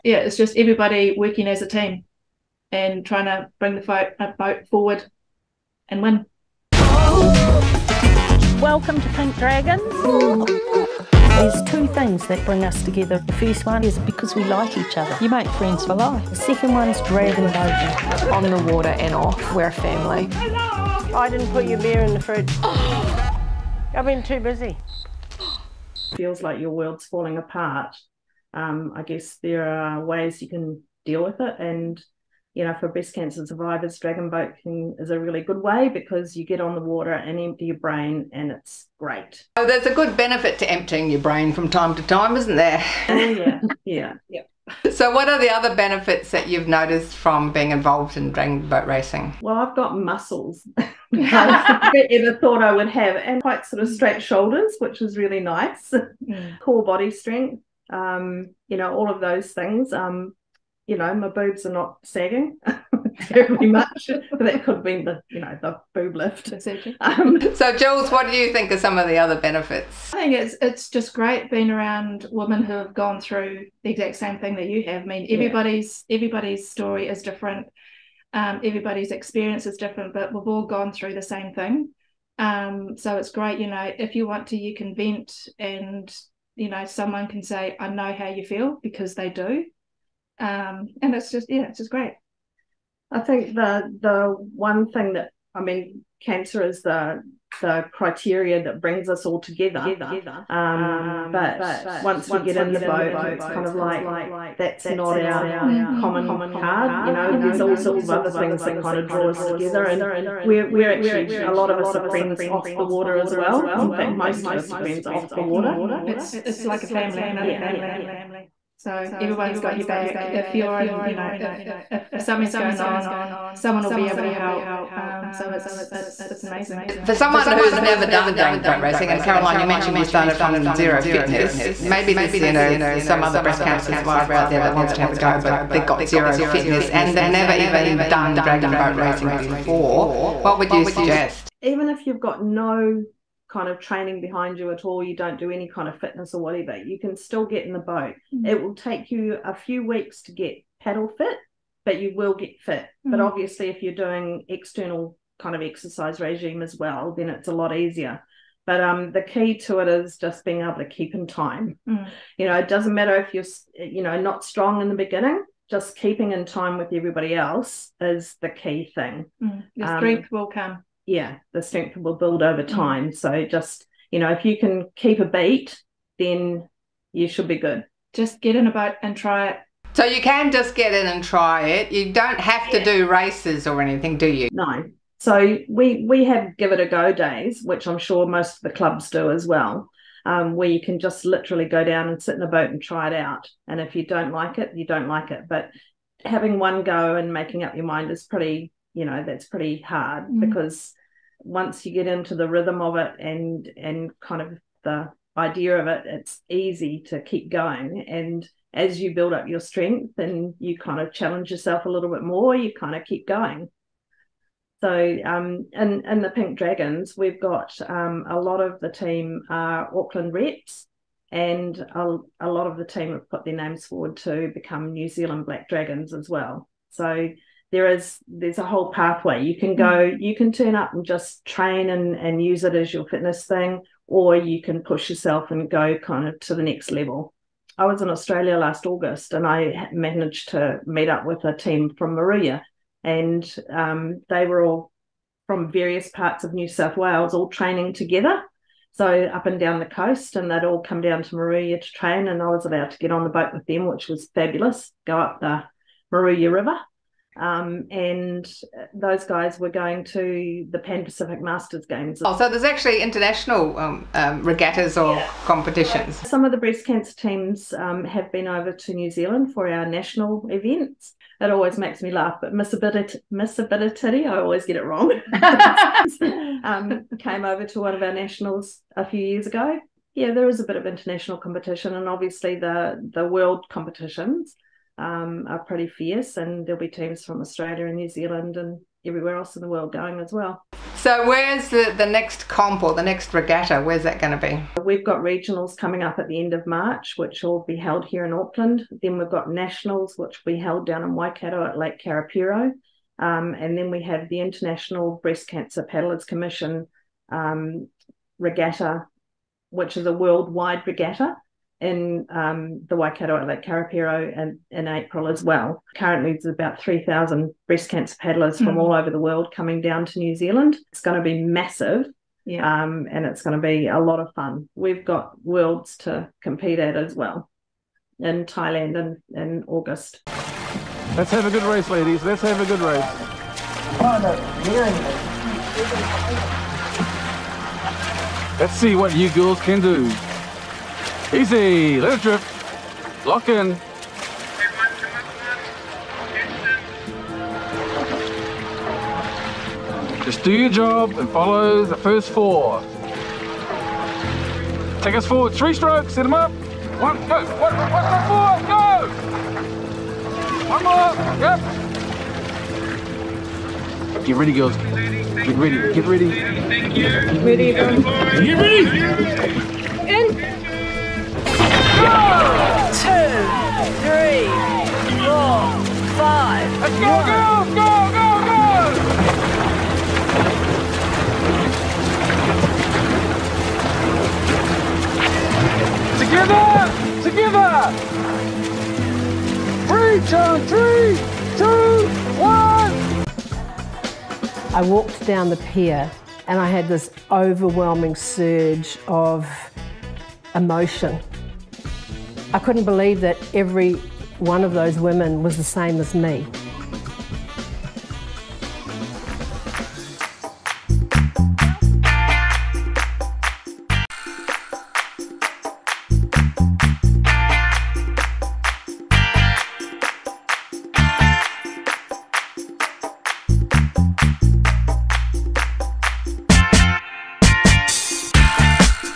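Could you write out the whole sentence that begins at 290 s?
So where's the, the next comp or the next regatta?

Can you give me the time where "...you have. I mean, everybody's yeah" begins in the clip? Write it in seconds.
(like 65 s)
74 s.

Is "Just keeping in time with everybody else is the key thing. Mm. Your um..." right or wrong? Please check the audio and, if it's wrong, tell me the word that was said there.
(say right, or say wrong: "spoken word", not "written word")
right.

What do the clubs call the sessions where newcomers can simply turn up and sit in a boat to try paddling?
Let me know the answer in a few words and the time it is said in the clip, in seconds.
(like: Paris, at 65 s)
Give it a go days, at 186 s.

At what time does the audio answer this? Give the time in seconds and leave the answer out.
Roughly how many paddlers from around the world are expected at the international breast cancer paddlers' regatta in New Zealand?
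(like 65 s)
316 s.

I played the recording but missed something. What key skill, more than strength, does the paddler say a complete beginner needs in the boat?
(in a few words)
Keeping in time.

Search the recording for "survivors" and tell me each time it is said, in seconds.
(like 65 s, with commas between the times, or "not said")
33 s, 133 s.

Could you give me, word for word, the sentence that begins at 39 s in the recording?
Oh, there's a good benefit to emptying your brain from time to time, isn't there?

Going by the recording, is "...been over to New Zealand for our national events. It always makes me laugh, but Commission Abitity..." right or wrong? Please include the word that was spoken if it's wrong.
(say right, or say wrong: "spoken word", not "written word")
wrong: "Miss", not "Commission".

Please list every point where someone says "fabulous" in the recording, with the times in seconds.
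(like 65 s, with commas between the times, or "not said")
254 s.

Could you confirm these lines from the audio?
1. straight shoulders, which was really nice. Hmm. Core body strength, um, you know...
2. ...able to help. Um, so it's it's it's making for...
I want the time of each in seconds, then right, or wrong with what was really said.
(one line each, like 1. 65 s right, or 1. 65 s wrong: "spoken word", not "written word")
1. 53 s right
2. 124 s wrong: "amazing", not "making".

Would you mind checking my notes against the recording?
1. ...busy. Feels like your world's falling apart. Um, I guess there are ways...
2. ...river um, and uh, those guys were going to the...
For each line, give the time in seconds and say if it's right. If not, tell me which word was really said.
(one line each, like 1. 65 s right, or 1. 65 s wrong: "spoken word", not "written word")
1. 24 s right
2. 256 s right.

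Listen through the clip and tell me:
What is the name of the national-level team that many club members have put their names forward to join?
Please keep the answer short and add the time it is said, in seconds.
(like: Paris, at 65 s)
New Zealand Black Dragons, at 224 s.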